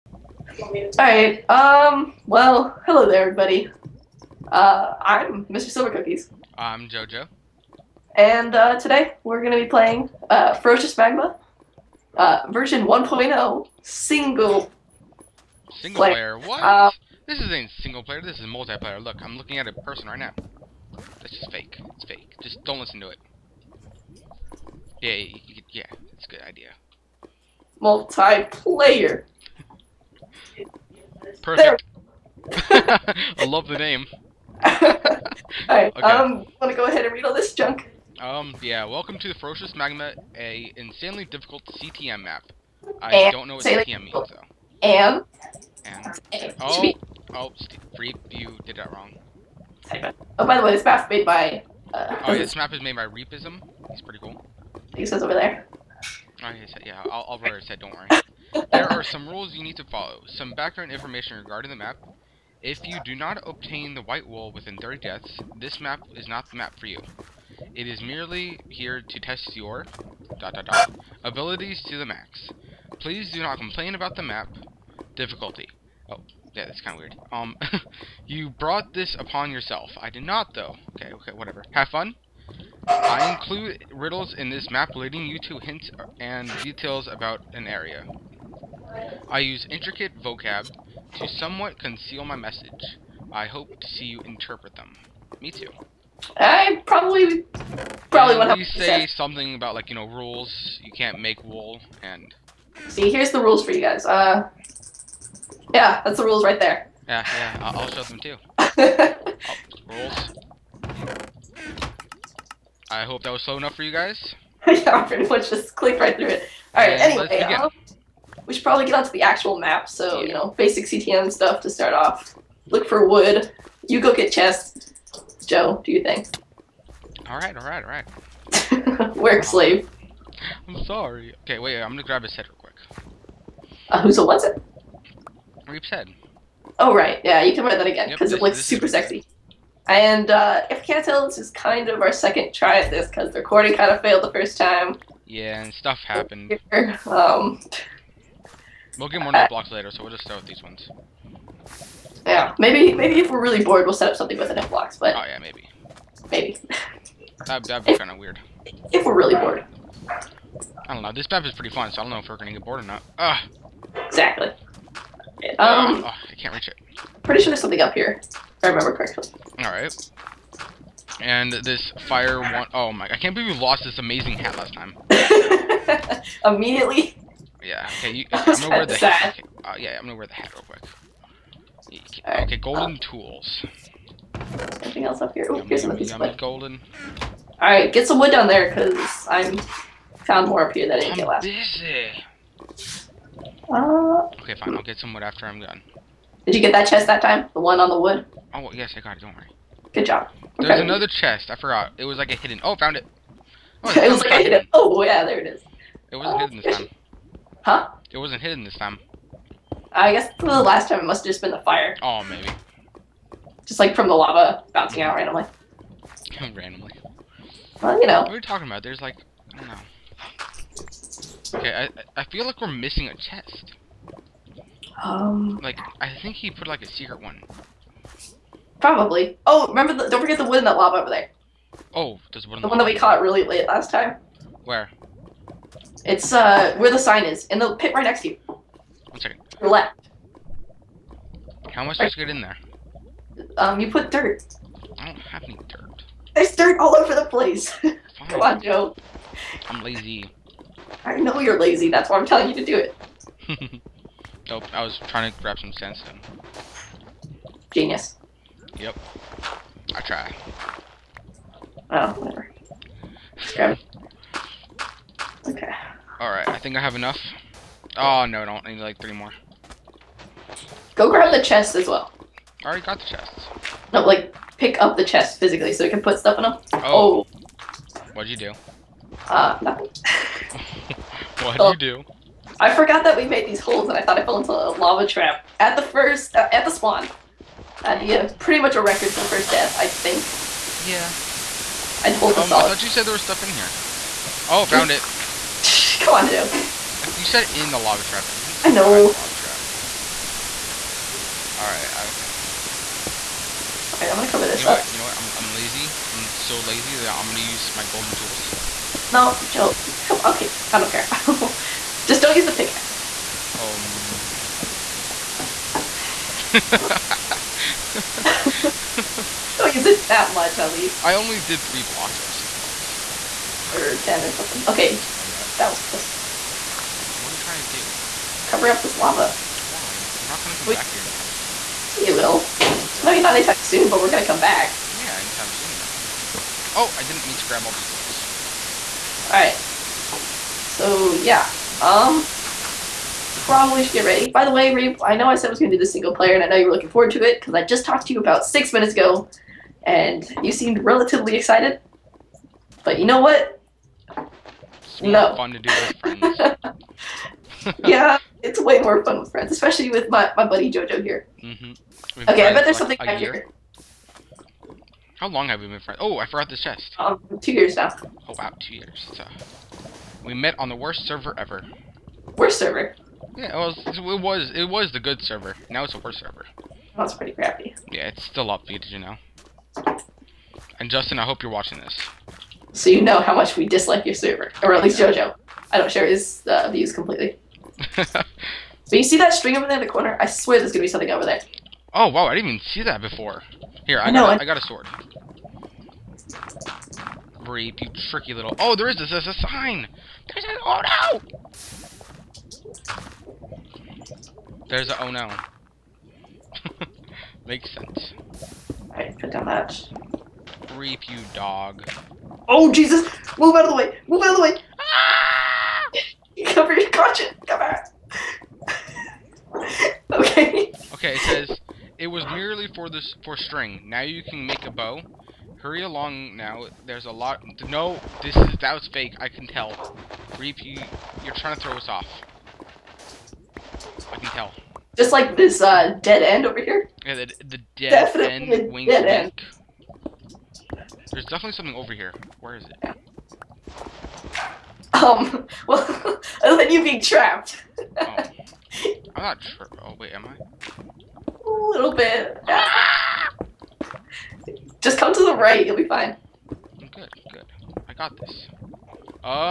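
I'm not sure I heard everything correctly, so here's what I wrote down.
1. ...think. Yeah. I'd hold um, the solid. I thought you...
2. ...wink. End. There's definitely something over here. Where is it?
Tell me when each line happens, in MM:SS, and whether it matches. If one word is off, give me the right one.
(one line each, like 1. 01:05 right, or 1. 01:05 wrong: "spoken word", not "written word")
1. 04:49 right
2. 07:18 right.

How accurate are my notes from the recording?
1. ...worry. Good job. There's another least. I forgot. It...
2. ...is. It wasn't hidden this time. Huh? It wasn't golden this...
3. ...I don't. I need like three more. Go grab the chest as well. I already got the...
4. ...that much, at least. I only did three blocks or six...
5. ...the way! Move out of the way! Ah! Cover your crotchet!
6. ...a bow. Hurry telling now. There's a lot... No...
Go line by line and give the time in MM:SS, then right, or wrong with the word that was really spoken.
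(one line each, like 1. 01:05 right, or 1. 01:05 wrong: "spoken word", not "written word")
1. 03:19 wrong: "chest", not "least"
2. 03:25 wrong: "hidden", not "golden"
3. 04:28 right
4. 05:20 right
5. 06:53 right
6. 07:04 wrong: "along", not "telling".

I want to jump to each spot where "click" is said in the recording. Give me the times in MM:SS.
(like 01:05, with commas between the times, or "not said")
01:55.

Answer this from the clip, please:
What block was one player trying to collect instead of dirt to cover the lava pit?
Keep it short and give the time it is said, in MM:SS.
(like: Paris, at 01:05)
Sandstone, at 04:15.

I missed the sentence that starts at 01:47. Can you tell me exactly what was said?
Yeah, yeah, I'll, show them too.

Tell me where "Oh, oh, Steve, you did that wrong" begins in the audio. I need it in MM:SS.
00:46.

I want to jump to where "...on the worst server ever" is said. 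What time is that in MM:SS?
06:10.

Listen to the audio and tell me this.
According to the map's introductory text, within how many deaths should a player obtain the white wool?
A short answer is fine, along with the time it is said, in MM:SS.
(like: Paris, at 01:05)
30, at 01:04.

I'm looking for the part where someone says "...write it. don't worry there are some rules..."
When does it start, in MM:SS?
00:57.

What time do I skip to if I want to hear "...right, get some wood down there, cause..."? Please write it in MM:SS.
03:07.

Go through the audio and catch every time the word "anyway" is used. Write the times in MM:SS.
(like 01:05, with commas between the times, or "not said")
01:57.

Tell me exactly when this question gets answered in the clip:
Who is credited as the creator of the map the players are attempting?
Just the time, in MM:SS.
00:53.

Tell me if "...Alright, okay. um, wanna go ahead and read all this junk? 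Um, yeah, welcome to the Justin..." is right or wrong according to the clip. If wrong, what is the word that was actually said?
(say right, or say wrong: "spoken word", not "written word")
wrong: "Ferocious", not "Justin".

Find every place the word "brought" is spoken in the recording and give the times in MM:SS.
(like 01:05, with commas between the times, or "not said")
01:18.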